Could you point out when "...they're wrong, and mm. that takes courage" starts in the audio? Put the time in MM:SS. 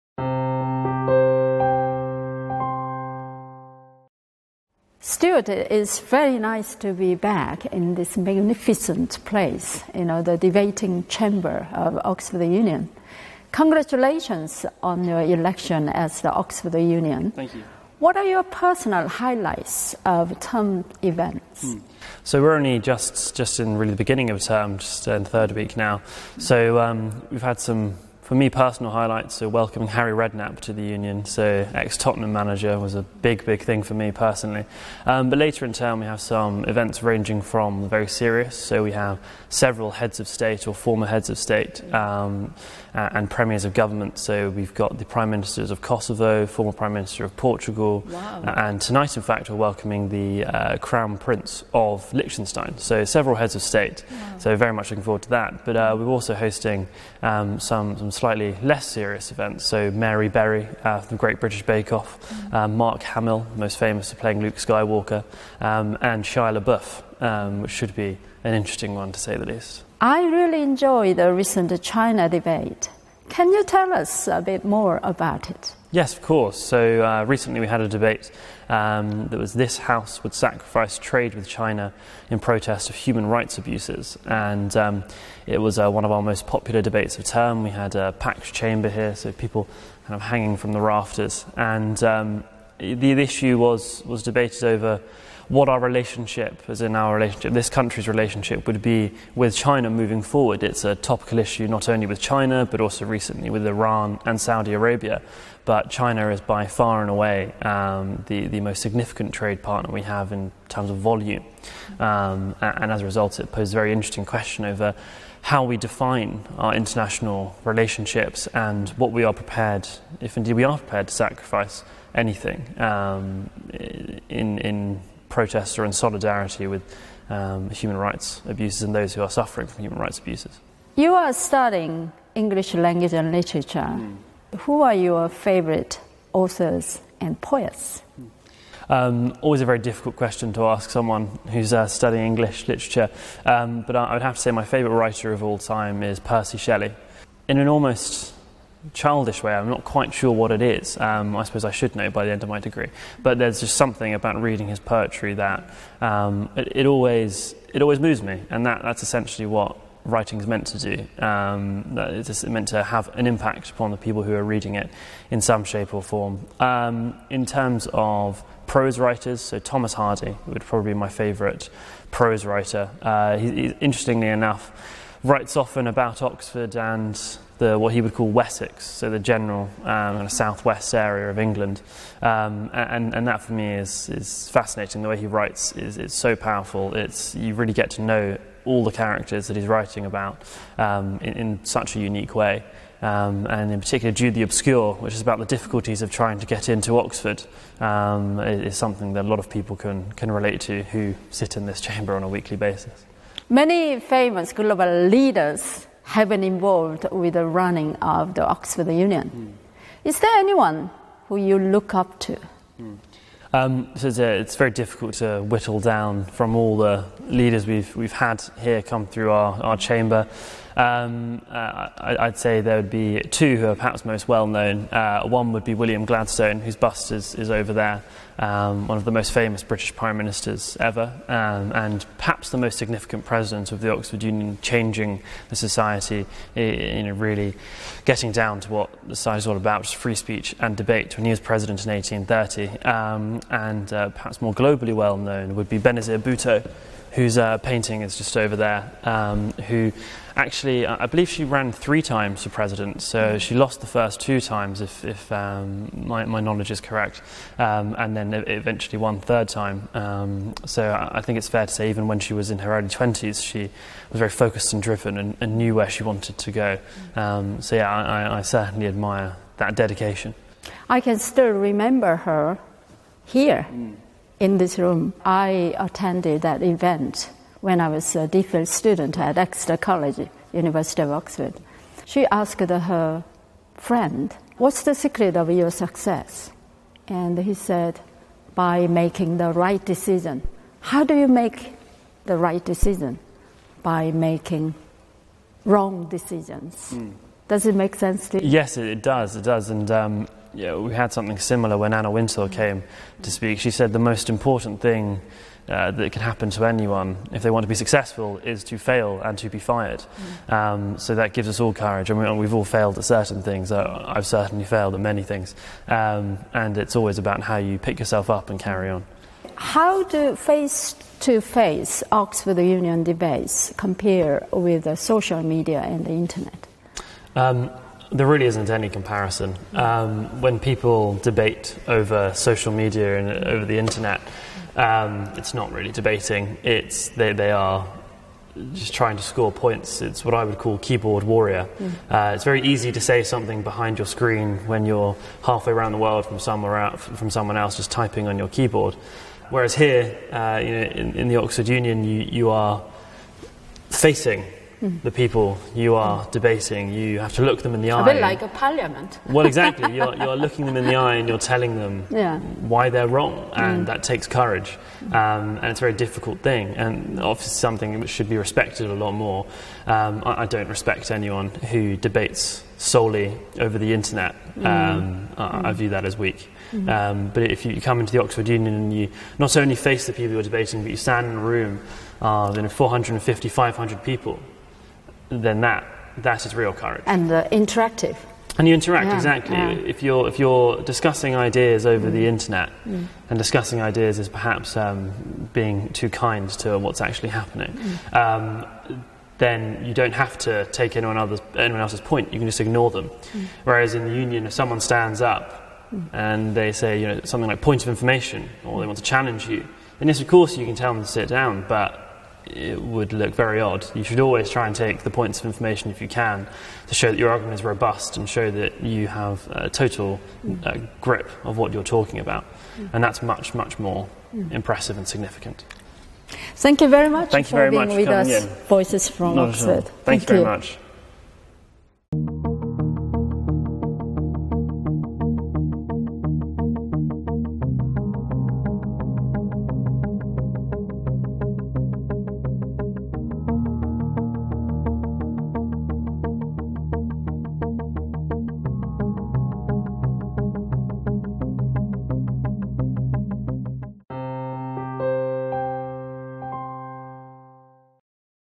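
06:02.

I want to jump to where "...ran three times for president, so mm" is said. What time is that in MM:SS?
04:11.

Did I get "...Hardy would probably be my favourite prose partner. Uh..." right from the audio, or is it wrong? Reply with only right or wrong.
wrong.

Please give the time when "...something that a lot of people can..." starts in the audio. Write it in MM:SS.
03:18.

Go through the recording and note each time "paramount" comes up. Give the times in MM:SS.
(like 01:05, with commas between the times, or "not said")
not said.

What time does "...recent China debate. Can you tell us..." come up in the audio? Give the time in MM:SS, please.
01:11.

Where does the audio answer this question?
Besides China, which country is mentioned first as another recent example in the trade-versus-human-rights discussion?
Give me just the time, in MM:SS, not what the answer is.
01:43.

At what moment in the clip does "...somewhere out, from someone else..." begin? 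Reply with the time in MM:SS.
05:46.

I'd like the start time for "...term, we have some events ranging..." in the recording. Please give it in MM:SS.
00:35.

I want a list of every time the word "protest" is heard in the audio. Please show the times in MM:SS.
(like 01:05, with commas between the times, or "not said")
01:22, 02:05.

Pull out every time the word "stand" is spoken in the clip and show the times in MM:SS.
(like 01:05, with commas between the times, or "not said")
06:20, 06:44.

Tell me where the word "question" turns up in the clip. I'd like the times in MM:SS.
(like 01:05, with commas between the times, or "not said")
01:54, 02:20.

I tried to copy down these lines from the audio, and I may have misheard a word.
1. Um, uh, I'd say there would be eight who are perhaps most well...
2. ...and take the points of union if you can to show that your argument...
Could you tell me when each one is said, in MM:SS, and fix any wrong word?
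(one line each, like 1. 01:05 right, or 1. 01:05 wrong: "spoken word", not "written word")
1. 03:40 wrong: "two", not "eight"
2. 06:54 wrong: "information", not "union".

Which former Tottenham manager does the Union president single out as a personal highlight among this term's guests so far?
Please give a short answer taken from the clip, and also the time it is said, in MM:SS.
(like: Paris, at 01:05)
Harry Redknapp, at 00:29.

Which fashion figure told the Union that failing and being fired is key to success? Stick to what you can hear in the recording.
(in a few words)
Anna Wintour.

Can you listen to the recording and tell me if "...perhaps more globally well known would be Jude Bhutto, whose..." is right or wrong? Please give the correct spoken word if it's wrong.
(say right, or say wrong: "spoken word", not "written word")
wrong: "Benazir", not "Jude".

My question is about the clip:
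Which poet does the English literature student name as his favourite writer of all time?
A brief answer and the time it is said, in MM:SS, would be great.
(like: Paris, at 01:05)
Percy Shelley, at 02:26.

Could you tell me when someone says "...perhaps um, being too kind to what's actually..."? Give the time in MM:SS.
06:34.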